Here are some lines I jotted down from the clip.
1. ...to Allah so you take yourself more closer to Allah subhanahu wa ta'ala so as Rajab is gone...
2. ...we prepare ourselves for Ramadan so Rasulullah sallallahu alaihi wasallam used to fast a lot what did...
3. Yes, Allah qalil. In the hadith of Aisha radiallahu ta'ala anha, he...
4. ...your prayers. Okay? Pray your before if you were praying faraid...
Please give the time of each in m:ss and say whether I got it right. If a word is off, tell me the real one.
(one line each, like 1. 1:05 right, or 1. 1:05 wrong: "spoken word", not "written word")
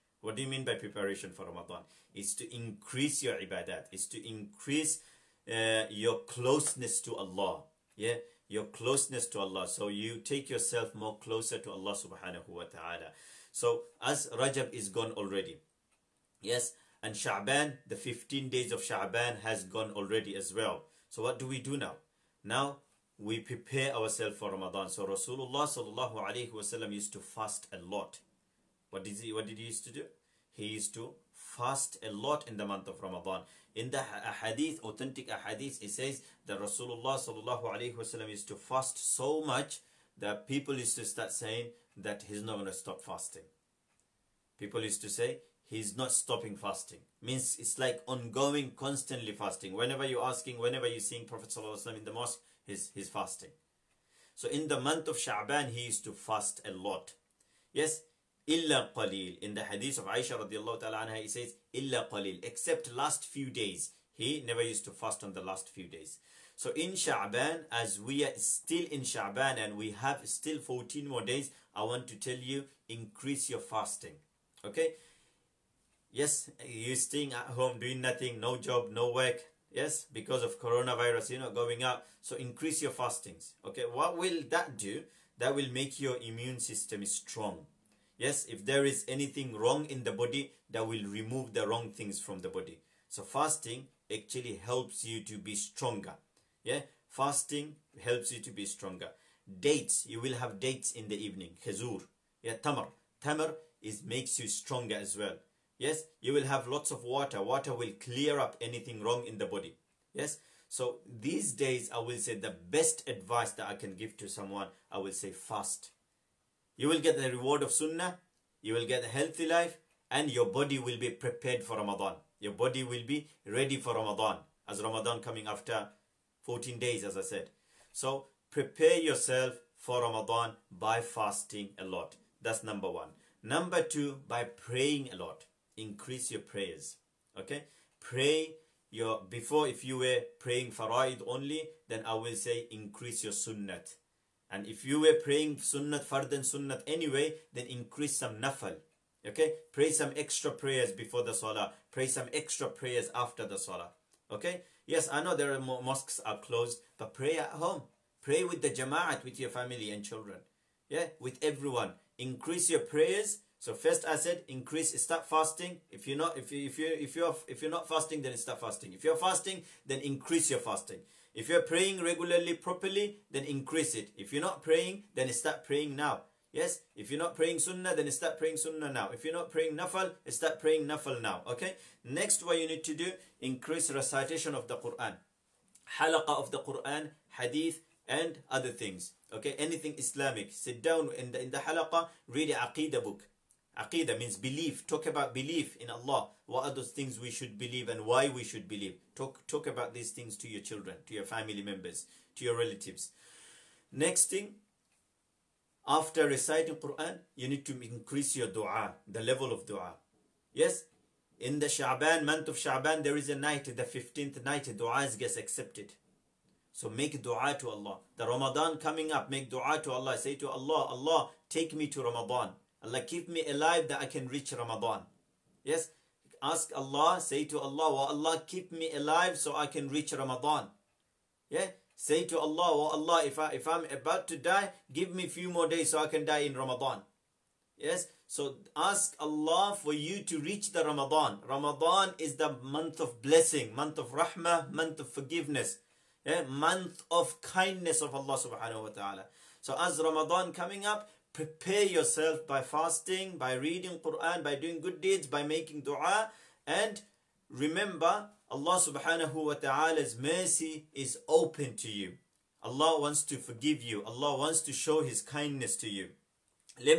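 1. 0:09 right
2. 0:23 right
3. 0:57 wrong: "Illa", not "Allah"
4. 2:16 right.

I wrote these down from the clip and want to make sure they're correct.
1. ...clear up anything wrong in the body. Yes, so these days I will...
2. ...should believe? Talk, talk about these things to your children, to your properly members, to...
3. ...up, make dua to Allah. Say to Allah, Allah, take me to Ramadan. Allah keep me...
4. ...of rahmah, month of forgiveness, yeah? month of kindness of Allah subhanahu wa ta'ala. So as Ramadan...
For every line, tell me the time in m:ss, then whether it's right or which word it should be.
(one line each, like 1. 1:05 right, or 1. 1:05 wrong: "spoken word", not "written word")
1. 1:48 right
2. 3:18 wrong: "family", not "properly"
3. 3:39 right
4. 4:03 right.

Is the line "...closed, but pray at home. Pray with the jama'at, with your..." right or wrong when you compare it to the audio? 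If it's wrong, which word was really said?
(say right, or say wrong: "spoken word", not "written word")
right.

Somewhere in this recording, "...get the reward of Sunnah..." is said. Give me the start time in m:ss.
1:57.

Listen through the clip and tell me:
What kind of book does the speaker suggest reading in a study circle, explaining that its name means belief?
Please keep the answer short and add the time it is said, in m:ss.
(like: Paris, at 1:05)
Aqidah book, at 3:12.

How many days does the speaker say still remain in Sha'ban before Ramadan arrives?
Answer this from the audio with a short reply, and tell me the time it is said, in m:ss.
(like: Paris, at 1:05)
14, at 1:10.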